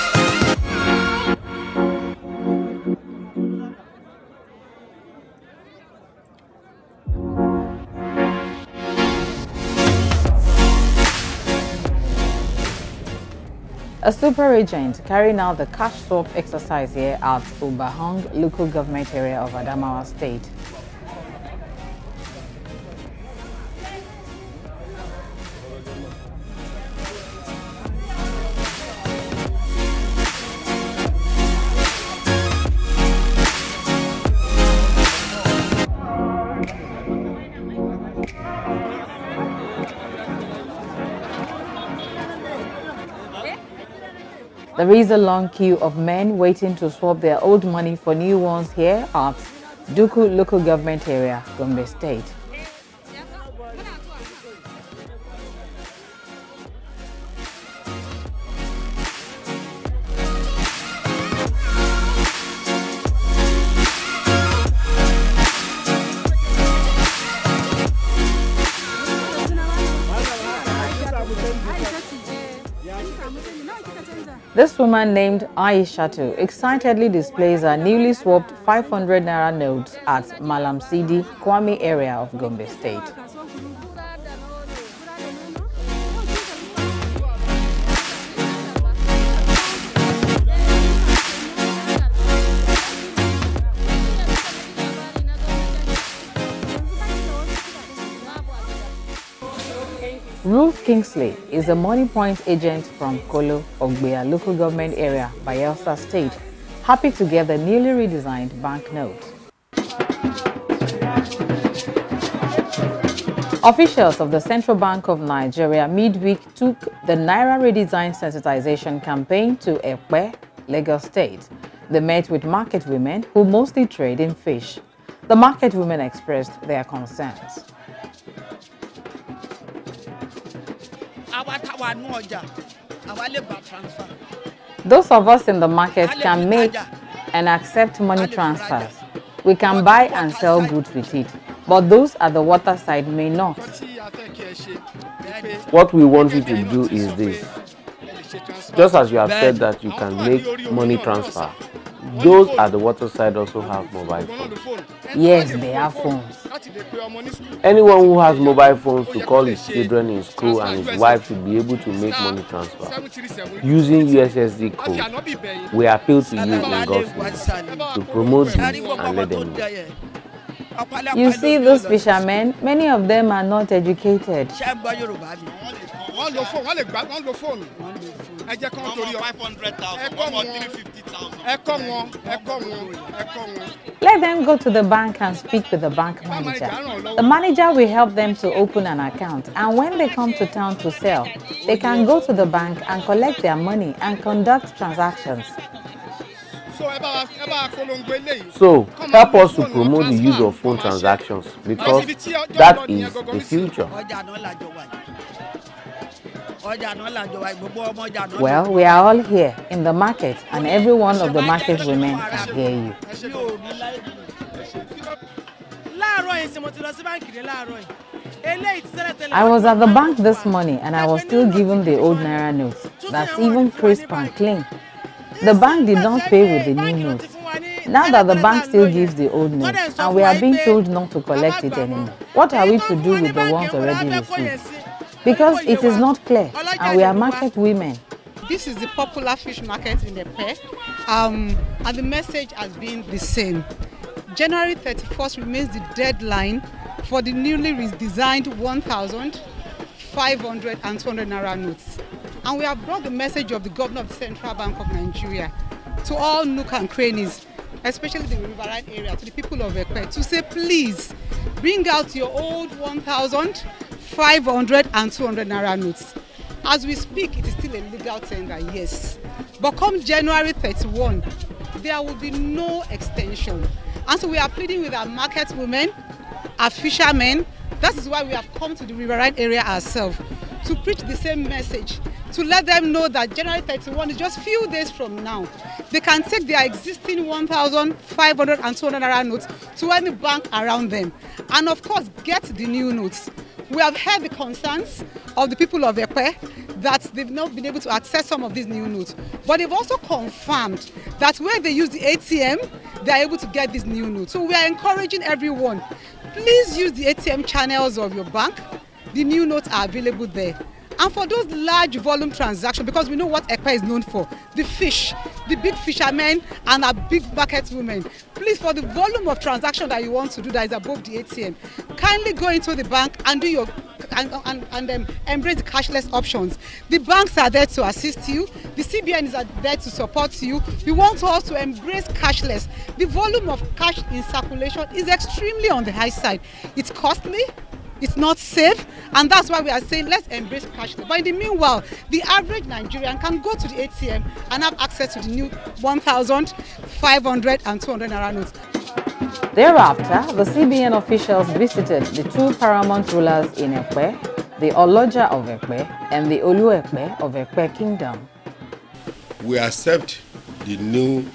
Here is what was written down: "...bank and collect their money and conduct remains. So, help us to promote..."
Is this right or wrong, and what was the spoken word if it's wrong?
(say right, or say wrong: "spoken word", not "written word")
wrong: "transactions", not "remains".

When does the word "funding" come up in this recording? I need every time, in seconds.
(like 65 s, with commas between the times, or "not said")
not said.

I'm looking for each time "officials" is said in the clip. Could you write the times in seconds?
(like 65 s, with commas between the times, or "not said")
113 s, 350 s.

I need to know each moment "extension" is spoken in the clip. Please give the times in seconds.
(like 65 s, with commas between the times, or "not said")
272 s.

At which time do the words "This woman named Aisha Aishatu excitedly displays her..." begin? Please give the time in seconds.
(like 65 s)
74 s.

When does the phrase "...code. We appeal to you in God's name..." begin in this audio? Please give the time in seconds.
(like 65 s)
164 s.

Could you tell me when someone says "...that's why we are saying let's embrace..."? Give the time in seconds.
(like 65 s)
339 s.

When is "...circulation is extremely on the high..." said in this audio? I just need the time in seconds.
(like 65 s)
334 s.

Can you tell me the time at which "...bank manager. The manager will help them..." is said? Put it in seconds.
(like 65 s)
185 s.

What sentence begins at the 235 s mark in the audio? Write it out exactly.
because it is not clear and we are market women.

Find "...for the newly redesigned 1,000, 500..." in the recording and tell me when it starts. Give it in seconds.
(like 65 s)
247 s.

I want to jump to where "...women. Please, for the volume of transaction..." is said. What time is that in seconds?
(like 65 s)
317 s.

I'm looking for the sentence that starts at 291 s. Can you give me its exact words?
And of course, get the new notes.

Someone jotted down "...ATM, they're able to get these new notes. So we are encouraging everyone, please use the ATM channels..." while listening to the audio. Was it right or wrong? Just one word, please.
right.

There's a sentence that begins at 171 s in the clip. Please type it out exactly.
You see those fishermen, many of them are not educated.